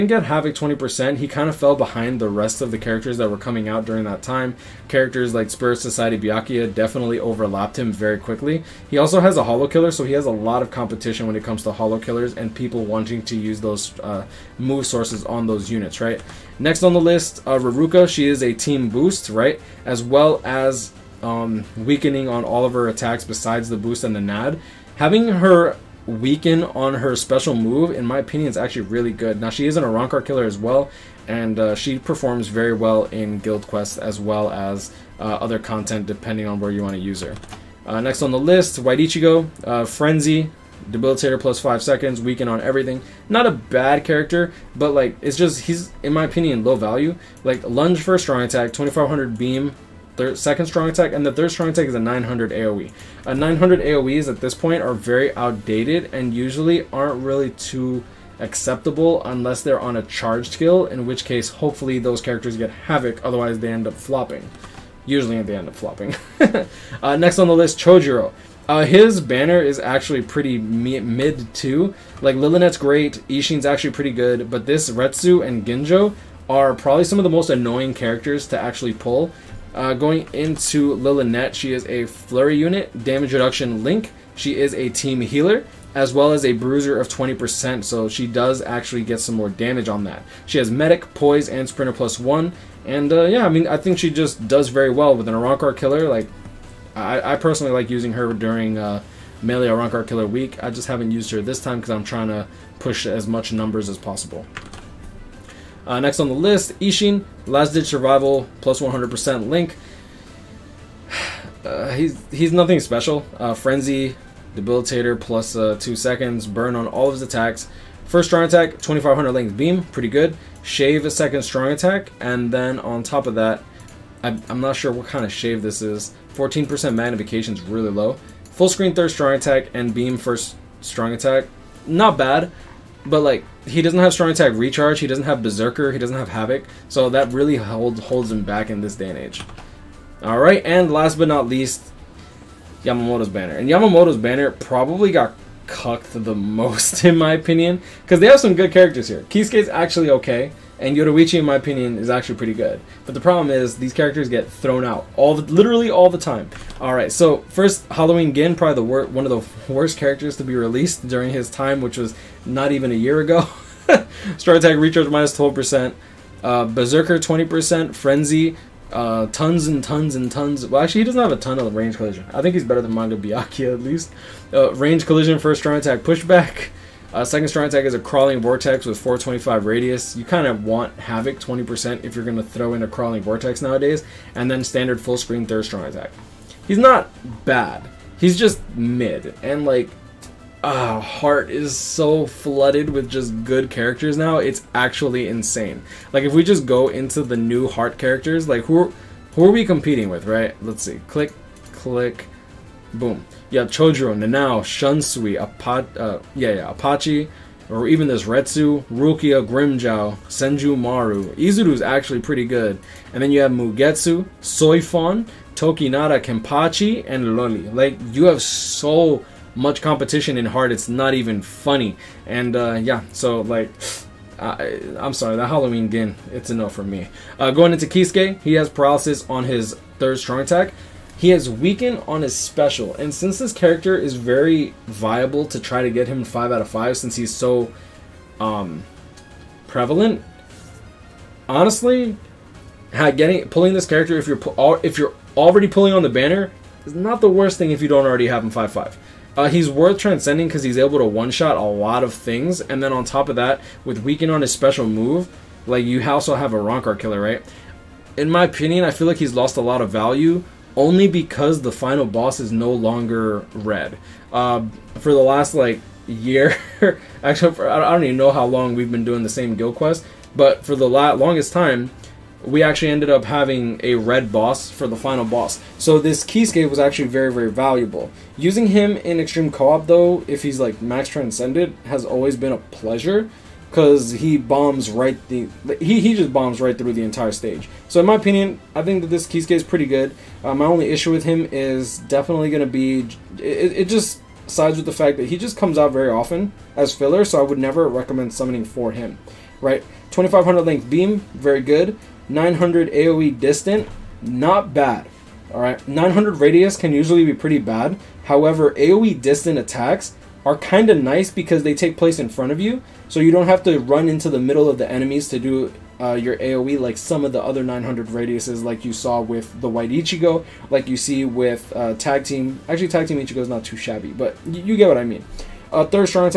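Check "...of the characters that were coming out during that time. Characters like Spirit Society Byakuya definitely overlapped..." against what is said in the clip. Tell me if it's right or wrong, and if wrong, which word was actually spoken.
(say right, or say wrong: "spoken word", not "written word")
right.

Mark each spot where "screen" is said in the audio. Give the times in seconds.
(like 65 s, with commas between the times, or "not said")
128 s, 185 s.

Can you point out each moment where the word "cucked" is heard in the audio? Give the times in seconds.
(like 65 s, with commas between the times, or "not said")
145 s.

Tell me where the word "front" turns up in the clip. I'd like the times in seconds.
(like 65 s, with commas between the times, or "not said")
312 s.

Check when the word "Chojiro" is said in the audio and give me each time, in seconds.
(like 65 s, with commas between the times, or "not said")
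67 s, 203 s.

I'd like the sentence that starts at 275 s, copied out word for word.
So this Kisuke was actually very, very valuable.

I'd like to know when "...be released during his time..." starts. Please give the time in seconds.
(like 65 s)
160 s.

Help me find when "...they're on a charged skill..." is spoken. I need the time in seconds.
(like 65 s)
59 s.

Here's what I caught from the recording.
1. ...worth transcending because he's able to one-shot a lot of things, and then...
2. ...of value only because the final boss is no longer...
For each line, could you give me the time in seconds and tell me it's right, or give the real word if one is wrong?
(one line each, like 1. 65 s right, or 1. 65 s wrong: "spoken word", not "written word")
1. 249 s right
2. 259 s right.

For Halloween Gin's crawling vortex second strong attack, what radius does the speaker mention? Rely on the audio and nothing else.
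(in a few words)
425.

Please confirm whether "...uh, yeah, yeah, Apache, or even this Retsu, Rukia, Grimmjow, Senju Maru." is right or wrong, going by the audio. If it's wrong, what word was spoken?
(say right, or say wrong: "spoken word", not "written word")
right.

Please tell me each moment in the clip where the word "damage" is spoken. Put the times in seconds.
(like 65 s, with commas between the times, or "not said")
83 s, 89 s.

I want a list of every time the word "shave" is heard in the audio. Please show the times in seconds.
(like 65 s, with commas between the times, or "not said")
120 s, 125 s.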